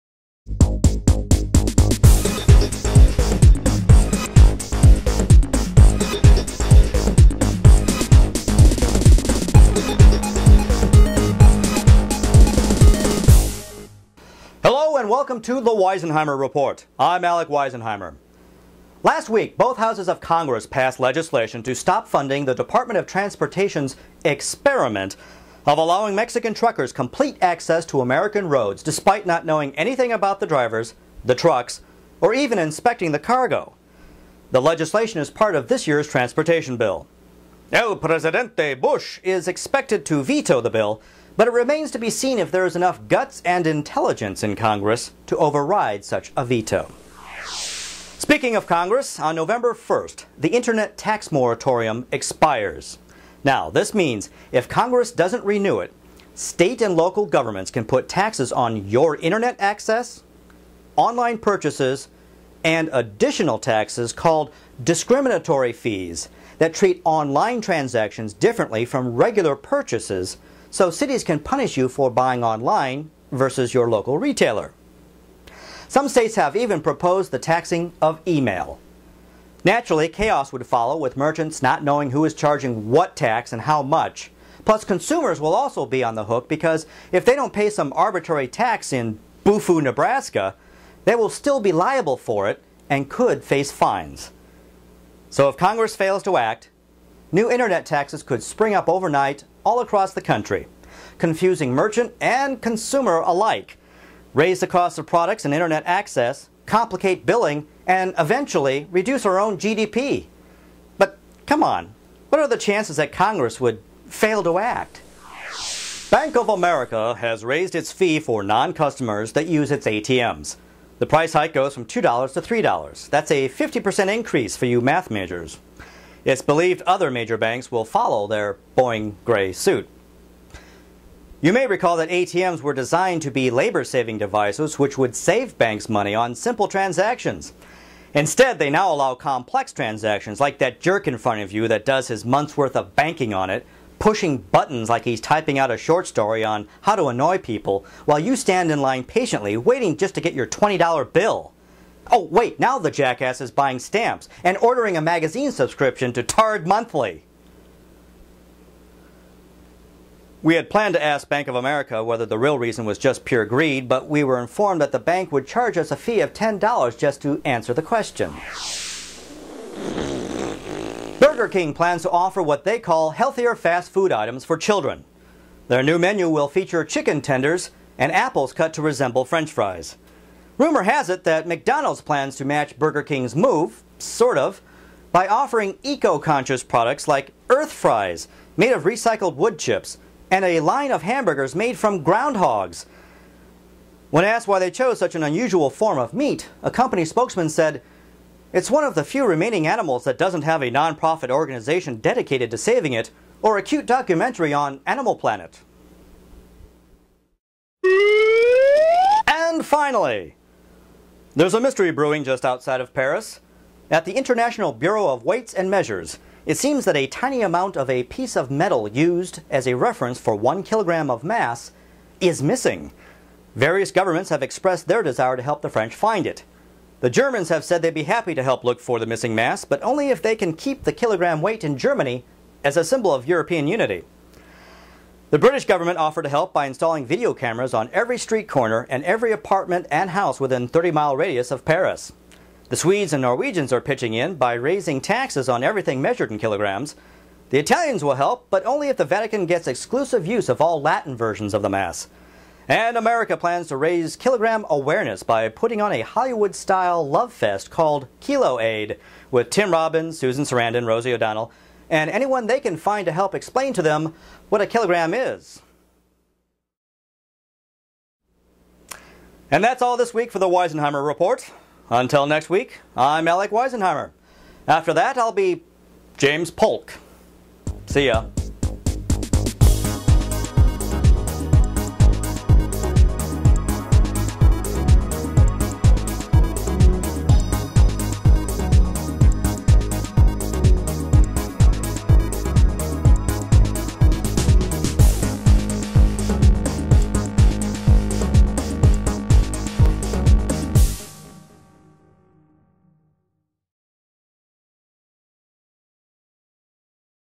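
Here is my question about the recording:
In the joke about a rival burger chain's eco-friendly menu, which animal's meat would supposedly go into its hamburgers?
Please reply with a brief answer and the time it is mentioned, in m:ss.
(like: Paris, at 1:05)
Groundhogs, at 3:12.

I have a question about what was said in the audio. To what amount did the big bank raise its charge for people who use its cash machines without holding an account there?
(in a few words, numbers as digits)
$3.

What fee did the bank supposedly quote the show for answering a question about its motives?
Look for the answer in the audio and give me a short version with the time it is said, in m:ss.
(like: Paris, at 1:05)
$10, at 2:46.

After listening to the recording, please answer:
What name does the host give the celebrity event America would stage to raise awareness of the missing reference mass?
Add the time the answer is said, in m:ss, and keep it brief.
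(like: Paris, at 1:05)
Kilo Aid, at 4:18.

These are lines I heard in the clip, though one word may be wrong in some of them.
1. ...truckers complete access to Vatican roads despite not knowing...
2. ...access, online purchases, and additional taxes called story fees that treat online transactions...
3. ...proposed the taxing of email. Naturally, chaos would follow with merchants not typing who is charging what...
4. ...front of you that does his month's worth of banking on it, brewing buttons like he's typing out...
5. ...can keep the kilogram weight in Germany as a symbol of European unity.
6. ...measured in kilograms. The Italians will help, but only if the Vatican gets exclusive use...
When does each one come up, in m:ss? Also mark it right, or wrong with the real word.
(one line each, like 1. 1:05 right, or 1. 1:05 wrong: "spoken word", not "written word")
1. 0:26 wrong: "American", not "Vatican"
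2. 0:59 wrong: "discriminatory", not "story"
3. 1:16 wrong: "knowing", not "typing"
4. 2:21 wrong: "pushing", not "brewing"
5. 3:50 right
6. 4:06 right.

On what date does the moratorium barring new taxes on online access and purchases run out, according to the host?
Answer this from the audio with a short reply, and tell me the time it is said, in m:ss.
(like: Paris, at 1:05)
November 1st, at 0:49.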